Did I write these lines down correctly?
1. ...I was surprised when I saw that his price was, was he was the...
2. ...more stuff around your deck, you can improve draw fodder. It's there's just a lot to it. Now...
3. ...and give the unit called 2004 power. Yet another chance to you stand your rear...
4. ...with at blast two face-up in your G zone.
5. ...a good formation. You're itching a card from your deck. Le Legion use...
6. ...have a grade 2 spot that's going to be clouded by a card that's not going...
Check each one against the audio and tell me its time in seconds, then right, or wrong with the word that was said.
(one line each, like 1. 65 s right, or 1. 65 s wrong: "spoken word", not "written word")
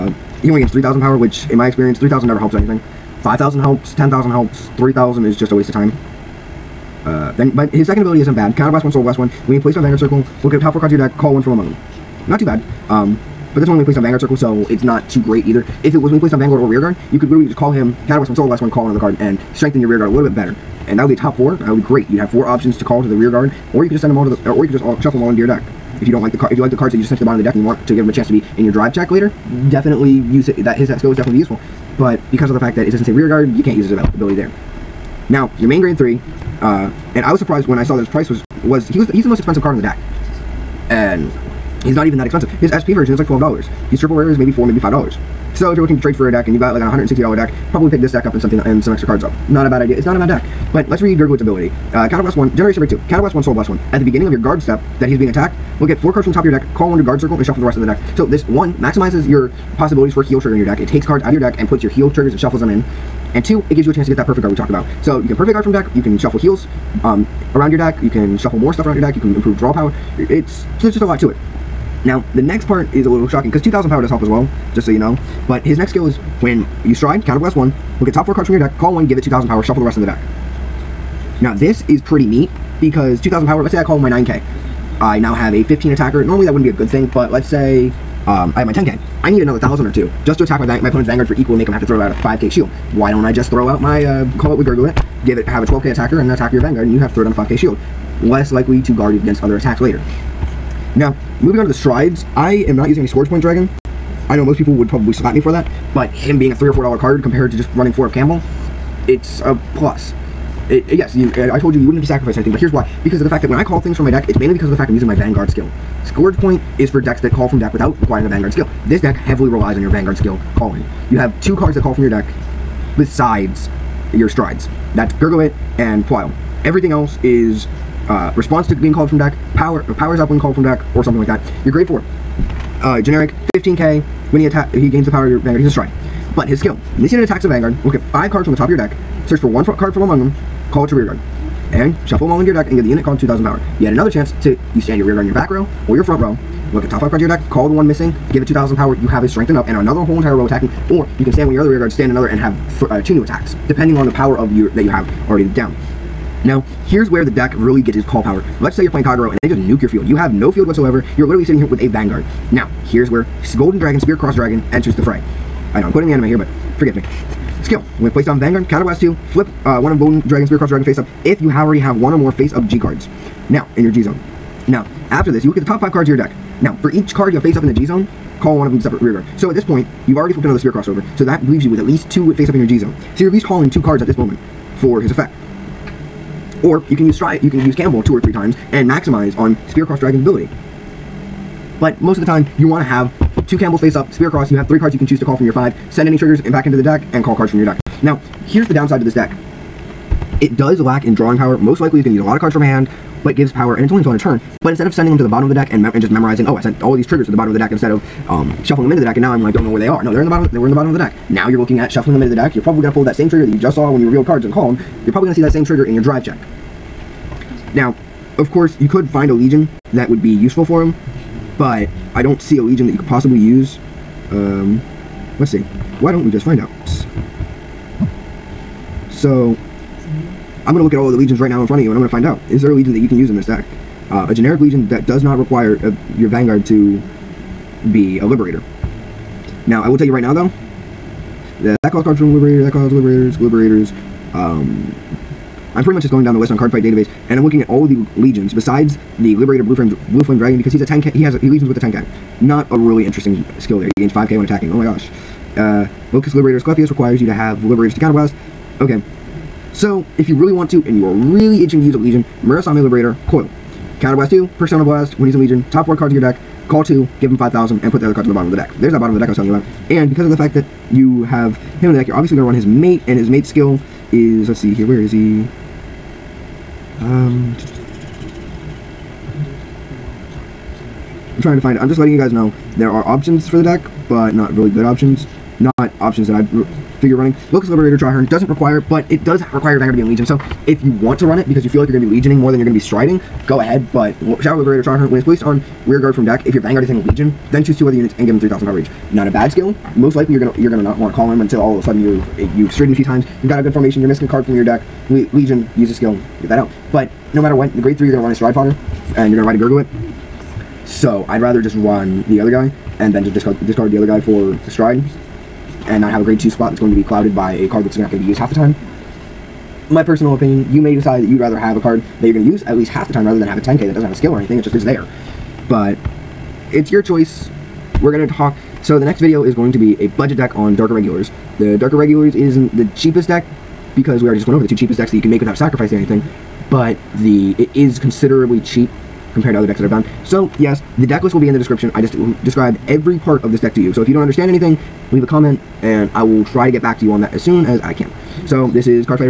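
1. 37 s right
2. 68 s wrong: "power", not "fodder"
3. 142 s wrong: "2000", not "2004"
4. 181 s wrong: "least", not "blast"
5. 303 s wrong: "missing", not "itching"
6. 316 s right.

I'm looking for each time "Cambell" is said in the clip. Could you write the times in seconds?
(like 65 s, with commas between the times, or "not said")
108 s, 187 s, 193 s.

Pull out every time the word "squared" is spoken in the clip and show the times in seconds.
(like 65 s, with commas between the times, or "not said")
not said.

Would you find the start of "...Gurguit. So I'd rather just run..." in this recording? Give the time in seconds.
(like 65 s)
309 s.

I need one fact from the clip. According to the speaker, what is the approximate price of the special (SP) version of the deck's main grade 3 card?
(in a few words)
$12.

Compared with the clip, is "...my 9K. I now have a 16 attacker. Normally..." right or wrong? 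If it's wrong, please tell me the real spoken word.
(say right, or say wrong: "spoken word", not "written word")
wrong: "15", not "16".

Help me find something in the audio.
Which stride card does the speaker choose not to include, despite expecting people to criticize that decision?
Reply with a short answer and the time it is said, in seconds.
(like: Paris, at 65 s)
Scourge Point Dragon, at 103 s.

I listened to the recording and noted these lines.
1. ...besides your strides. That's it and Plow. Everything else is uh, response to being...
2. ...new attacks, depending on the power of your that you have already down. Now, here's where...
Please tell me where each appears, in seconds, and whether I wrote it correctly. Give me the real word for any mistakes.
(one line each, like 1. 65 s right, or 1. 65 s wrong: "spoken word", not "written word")
1. 122 s right
2. 153 s right.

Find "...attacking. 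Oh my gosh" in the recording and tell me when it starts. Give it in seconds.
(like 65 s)
254 s.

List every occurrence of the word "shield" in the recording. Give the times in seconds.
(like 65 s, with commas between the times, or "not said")
92 s, 97 s.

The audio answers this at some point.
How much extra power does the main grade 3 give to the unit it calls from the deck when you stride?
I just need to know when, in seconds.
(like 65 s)
79 s.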